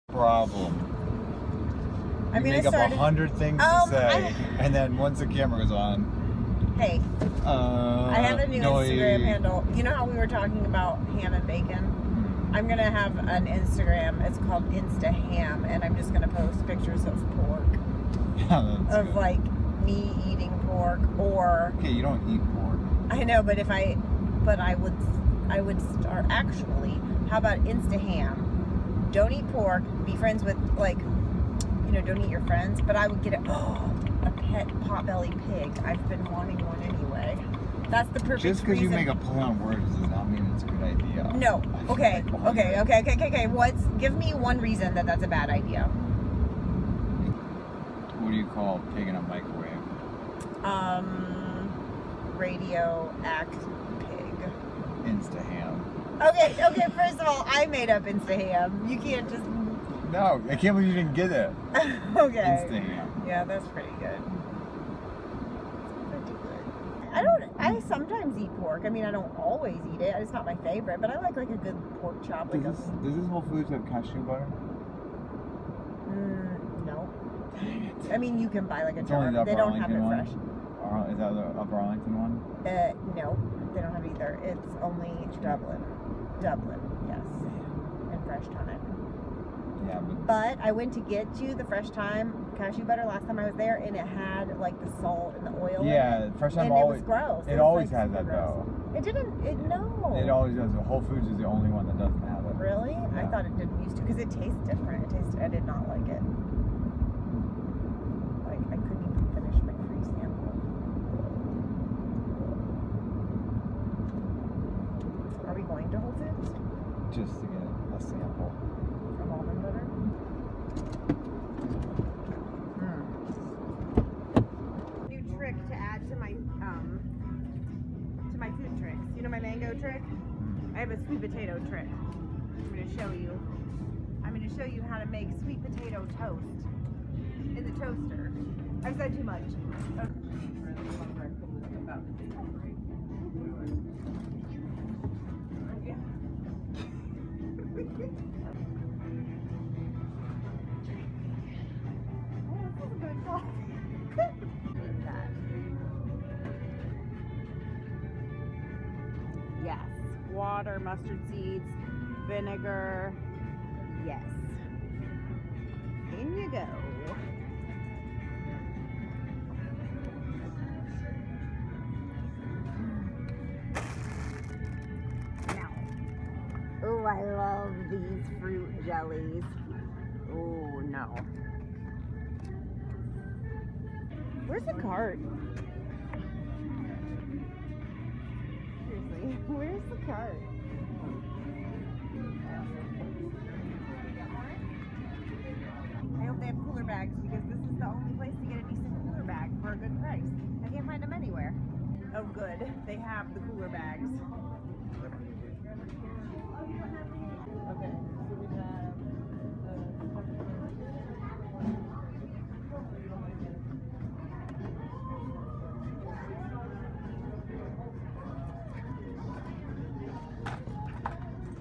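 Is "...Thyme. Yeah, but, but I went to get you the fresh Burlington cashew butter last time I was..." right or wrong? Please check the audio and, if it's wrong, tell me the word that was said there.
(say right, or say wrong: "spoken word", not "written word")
wrong: "Thyme", not "Burlington".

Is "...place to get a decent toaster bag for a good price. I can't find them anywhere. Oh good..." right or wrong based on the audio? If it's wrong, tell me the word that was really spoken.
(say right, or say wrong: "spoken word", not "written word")
wrong: "cooler", not "toaster".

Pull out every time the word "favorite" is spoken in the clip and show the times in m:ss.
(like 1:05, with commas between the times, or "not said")
1:10.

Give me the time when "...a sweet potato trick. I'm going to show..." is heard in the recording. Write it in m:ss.
2:10.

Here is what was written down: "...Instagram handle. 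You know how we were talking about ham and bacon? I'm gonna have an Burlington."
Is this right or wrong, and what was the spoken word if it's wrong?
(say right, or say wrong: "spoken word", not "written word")
wrong: "Instagram", not "Burlington".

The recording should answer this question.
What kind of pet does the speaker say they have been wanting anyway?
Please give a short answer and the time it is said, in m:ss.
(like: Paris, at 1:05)
potbelly pig, at 0:34.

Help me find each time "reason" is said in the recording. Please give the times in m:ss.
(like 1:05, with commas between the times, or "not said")
0:44.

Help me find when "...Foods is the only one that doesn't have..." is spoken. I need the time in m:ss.
1:41.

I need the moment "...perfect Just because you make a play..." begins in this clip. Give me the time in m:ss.
0:38.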